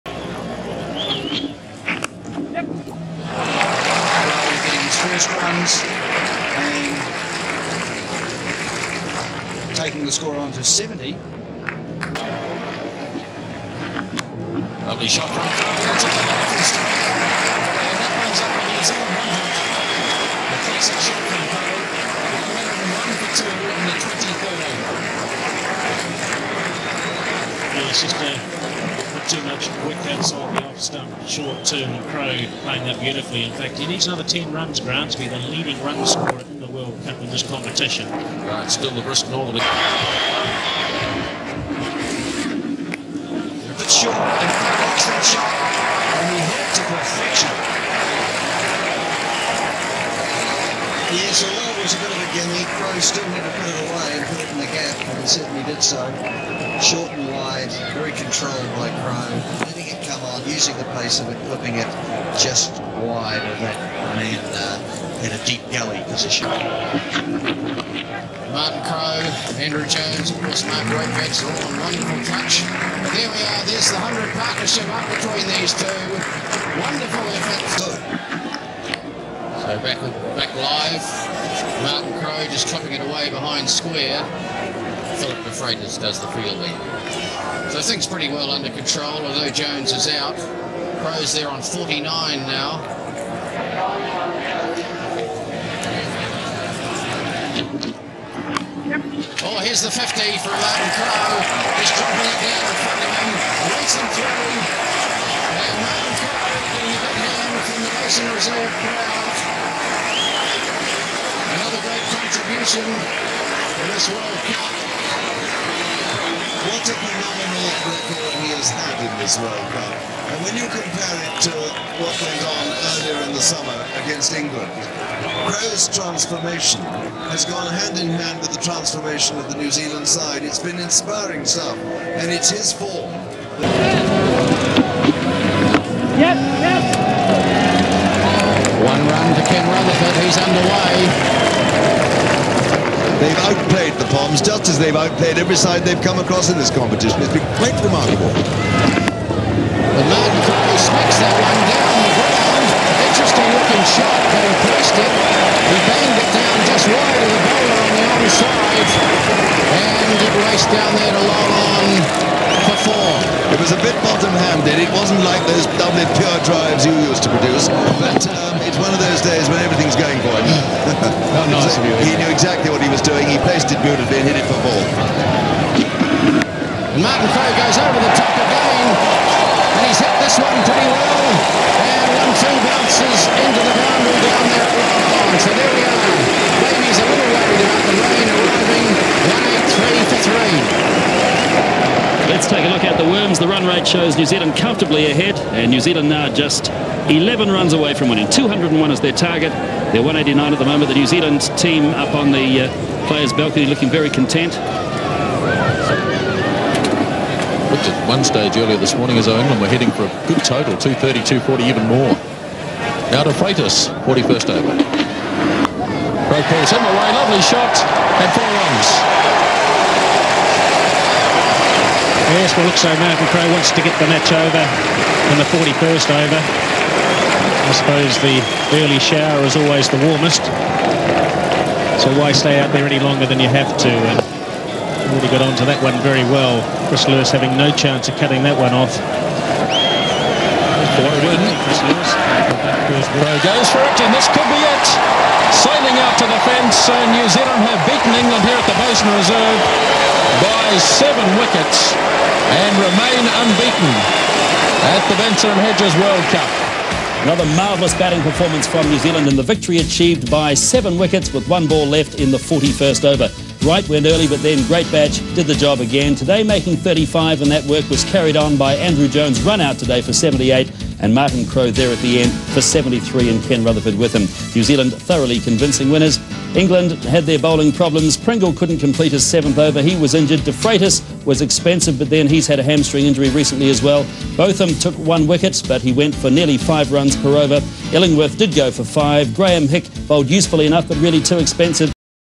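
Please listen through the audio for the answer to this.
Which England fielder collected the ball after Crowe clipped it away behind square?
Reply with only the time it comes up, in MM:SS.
01:25.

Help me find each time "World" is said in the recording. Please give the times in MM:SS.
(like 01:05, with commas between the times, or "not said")
00:36, 01:54, 01:59, 04:16.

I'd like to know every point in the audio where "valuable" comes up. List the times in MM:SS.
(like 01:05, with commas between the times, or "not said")
not said.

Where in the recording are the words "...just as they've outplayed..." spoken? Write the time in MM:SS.
02:24.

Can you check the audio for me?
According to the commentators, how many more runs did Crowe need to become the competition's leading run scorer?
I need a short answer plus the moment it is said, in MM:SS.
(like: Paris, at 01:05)
10, at 00:34.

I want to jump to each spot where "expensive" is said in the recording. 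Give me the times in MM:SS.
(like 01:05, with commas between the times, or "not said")
04:41, 04:51.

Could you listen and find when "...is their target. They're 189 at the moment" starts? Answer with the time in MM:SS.
03:18.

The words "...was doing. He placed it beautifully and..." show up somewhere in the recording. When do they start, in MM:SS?
02:52.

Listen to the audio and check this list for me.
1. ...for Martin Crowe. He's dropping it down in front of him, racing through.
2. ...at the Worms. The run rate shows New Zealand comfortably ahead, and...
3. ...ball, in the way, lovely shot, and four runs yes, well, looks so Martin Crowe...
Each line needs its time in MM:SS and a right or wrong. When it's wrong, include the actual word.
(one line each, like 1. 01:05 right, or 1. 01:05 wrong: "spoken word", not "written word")
1. 01:40 right
2. 03:12 right
3. 03:36 right.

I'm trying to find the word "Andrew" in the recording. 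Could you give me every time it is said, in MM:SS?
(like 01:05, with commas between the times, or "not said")
01:09, 04:28.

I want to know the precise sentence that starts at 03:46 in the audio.
I suppose the early shower is always the warmest.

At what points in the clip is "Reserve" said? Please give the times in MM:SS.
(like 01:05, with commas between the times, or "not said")
01:48, 04:09.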